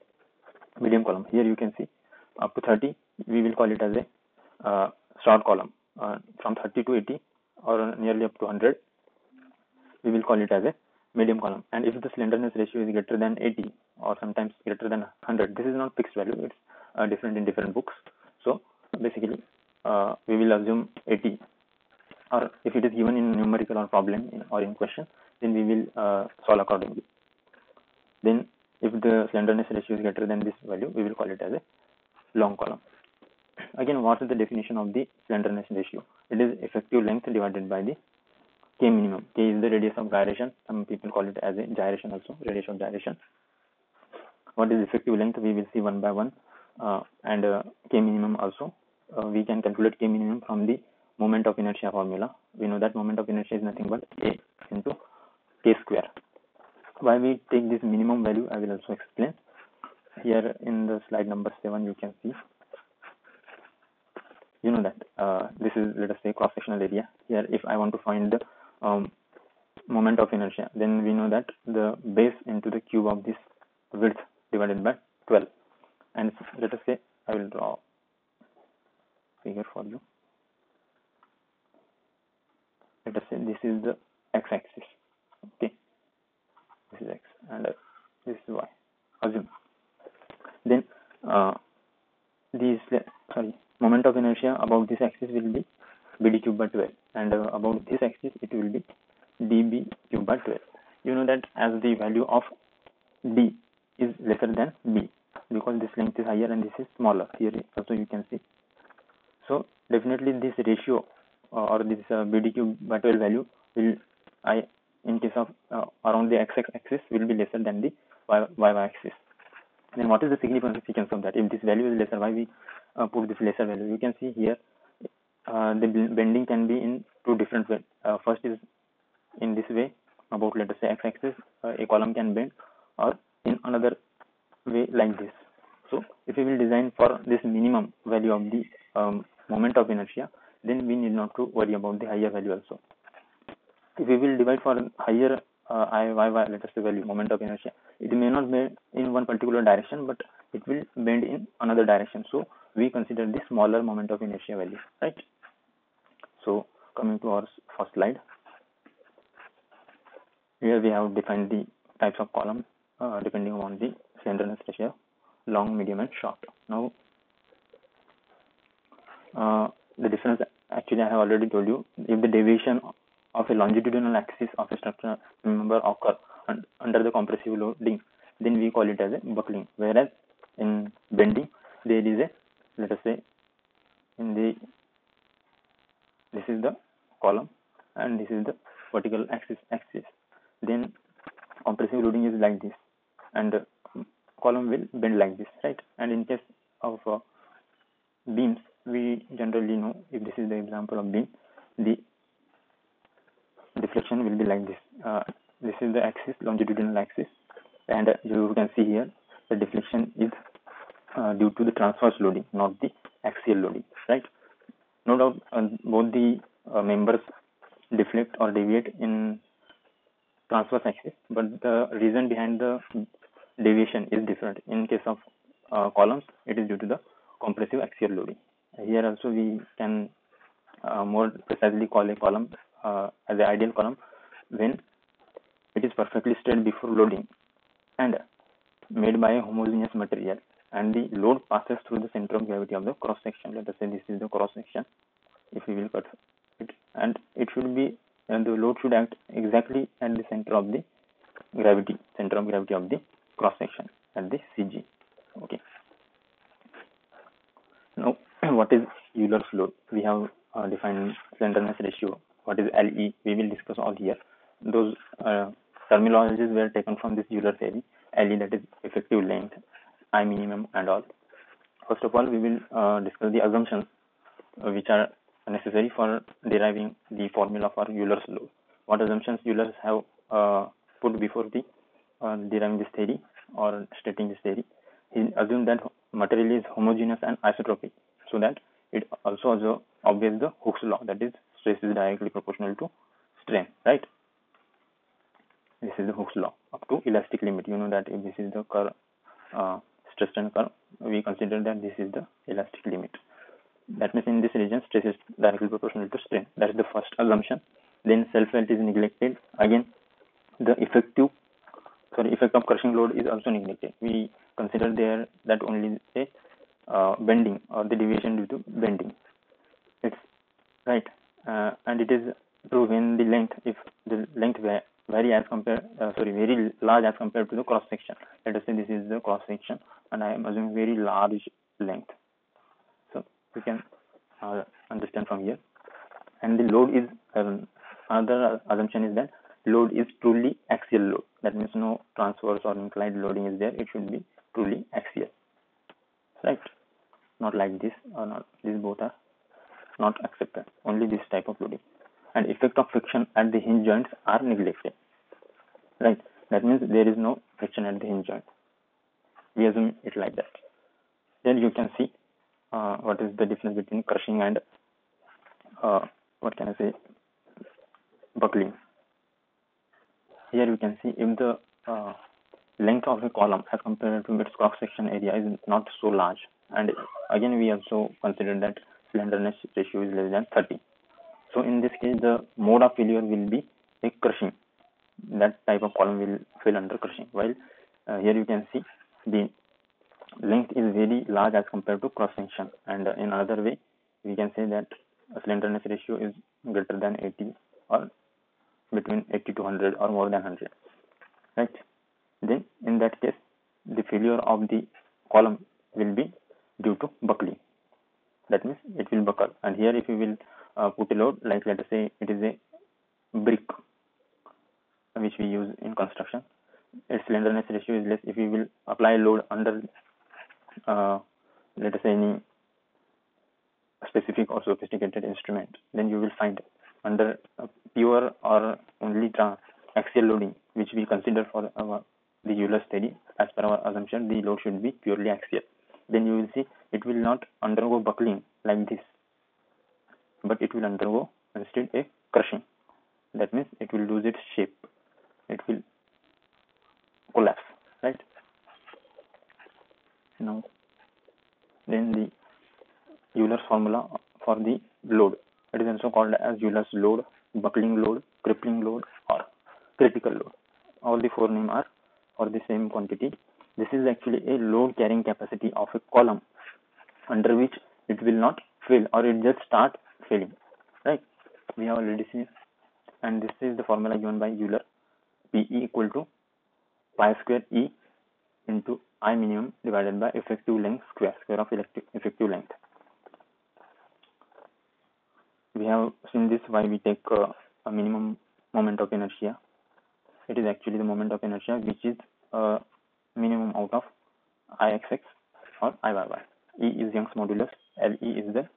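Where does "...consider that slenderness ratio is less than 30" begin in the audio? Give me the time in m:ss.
6:18.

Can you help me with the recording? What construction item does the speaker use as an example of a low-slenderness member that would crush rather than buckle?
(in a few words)
brick.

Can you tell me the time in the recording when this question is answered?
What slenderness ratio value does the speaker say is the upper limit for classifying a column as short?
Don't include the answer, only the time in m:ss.
0:02.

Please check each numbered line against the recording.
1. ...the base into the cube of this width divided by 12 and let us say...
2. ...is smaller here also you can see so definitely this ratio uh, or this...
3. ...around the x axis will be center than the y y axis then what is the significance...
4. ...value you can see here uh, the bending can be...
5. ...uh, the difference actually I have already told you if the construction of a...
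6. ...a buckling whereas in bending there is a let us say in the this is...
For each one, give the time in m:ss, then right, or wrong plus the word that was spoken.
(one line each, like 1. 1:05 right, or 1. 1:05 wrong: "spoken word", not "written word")
1. 1:11 right
2. 1:46 right
3. 1:56 wrong: "lesser", not "center"
4. 2:03 right
5. 2:49 wrong: "deviation", not "construction"
6. 2:59 right.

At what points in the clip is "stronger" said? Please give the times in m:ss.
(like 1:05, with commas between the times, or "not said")
not said.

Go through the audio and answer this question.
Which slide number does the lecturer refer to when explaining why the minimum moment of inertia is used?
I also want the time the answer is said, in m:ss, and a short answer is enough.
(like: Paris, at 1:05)
7, at 1:01.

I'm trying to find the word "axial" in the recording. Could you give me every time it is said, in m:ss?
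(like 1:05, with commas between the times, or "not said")
3:33, 3:47, 5:40, 5:44, 7:09, 7:15.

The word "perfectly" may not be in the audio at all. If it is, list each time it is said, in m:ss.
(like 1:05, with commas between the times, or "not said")
3:55.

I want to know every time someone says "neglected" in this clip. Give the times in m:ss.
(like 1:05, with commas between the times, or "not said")
5:08, 5:13, 5:54.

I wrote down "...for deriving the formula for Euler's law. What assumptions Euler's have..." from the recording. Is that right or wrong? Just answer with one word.
right.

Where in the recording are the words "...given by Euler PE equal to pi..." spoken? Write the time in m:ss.
7:54.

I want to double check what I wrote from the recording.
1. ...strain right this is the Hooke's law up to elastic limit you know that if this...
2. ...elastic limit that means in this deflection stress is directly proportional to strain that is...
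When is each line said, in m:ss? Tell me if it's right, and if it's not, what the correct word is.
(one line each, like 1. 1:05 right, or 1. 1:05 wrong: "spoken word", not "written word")
1. 4:53 right
2. 5:02 wrong: "region", not "deflection".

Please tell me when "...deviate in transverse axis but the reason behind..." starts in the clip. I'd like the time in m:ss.
3:38.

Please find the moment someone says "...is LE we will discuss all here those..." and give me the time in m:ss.
4:22.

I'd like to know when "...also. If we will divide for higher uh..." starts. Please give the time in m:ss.
2:22.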